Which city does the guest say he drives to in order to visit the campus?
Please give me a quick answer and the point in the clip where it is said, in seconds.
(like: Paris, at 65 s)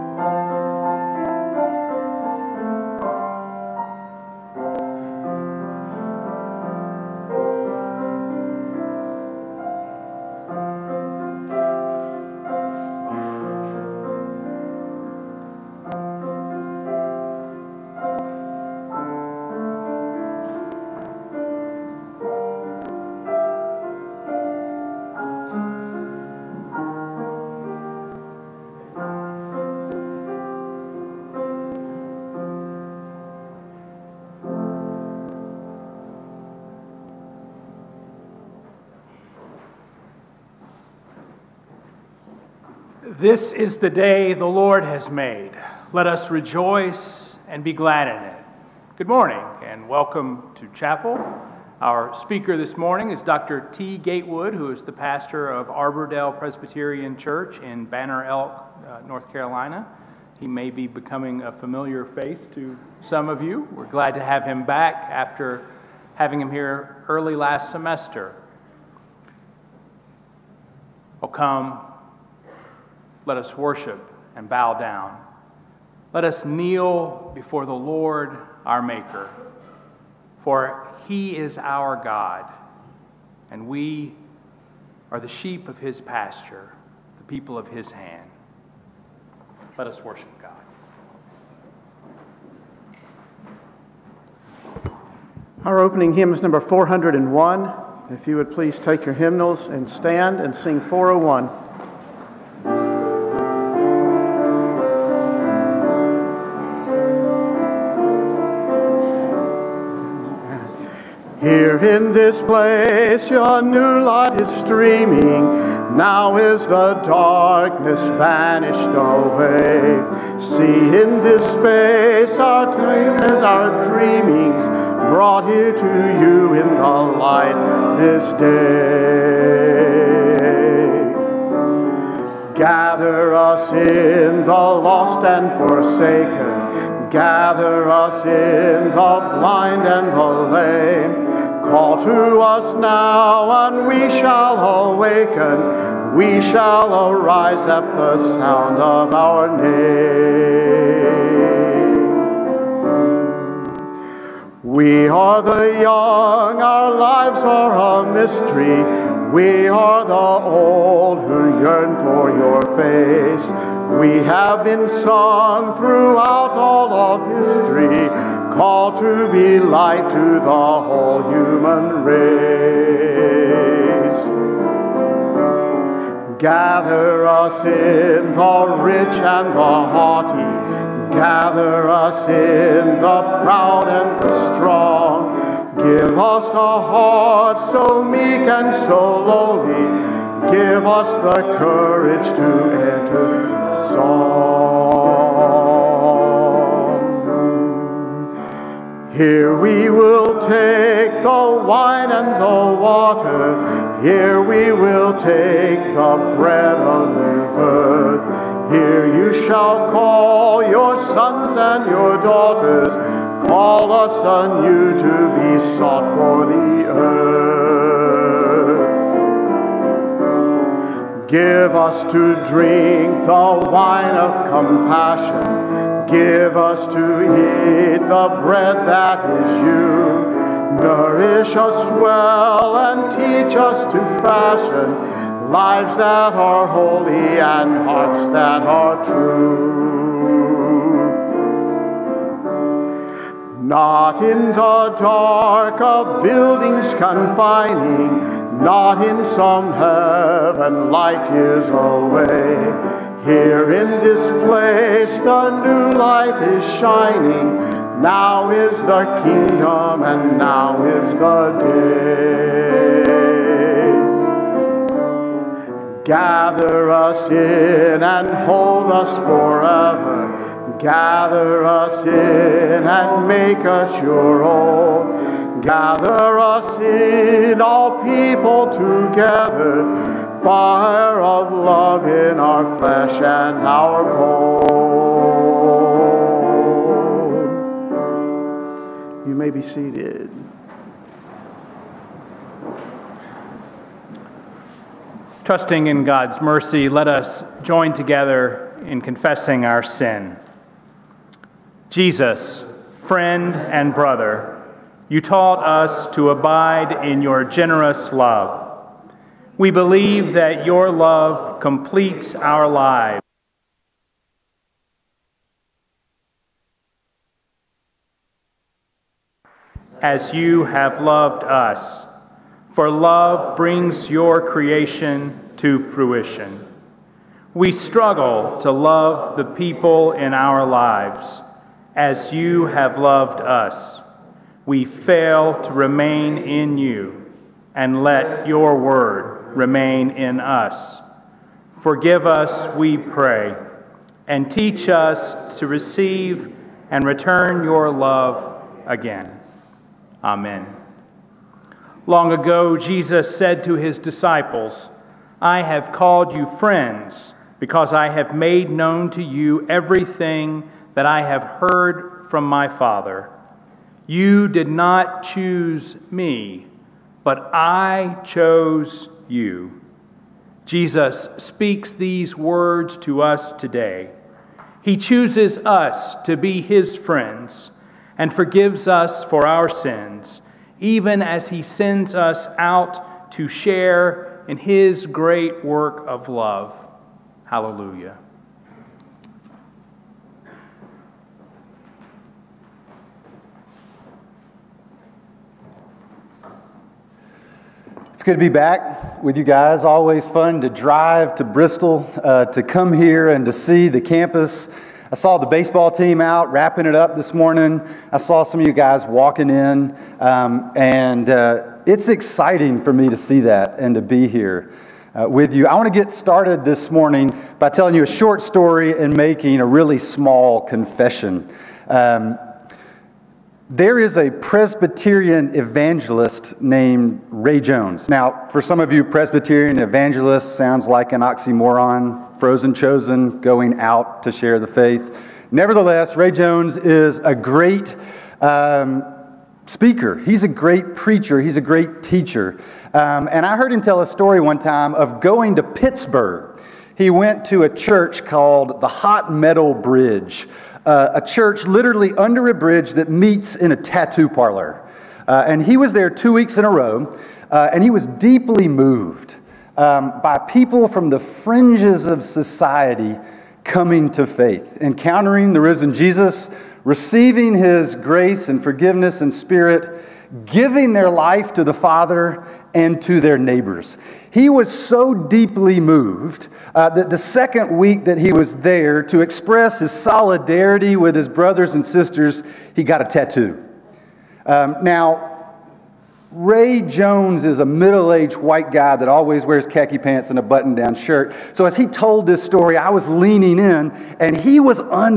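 Bristol, at 401 s.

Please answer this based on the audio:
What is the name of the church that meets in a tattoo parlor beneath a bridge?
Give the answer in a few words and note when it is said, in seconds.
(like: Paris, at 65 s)
Hot Metal Bridge, at 448 s.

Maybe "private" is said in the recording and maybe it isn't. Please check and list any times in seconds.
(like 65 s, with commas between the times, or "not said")
not said.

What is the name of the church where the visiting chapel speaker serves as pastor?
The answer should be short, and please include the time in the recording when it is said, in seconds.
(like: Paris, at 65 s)
Arbor Dale Presbyterian Church, at 55 s.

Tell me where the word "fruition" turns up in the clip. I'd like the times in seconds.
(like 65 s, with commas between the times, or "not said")
325 s.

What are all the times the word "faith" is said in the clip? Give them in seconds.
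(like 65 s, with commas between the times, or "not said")
434 s, 464 s.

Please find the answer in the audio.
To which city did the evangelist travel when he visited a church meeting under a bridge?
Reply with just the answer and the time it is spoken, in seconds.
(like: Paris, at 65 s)
Pittsburgh, at 445 s.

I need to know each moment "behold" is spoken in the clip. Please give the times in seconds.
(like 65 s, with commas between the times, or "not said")
not said.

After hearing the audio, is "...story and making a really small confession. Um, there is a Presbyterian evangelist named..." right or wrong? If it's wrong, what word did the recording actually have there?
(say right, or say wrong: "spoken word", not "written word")
right.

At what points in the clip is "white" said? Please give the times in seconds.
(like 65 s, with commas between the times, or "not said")
488 s.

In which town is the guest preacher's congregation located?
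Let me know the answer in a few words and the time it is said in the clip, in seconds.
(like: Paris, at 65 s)
Banner Elk, at 57 s.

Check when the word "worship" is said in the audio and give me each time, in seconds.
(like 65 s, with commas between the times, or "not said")
73 s, 90 s.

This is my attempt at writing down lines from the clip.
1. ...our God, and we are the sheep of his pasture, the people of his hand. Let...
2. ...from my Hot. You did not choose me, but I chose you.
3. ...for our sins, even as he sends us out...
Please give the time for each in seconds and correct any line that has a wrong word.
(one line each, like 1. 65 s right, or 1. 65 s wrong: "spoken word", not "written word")
1. 81 s right
2. 362 s wrong: "Father", not "Hot"
3. 379 s right.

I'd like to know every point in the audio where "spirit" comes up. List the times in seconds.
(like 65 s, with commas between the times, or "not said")
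469 s.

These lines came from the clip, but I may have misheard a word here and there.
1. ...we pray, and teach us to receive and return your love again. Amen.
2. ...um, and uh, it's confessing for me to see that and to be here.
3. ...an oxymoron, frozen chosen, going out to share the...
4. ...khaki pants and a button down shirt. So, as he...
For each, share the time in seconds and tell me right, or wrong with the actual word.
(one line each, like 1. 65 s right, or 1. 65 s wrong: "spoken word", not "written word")
1. 342 s right
2. 410 s wrong: "exciting", not "confessing"
3. 431 s right
4. 489 s right.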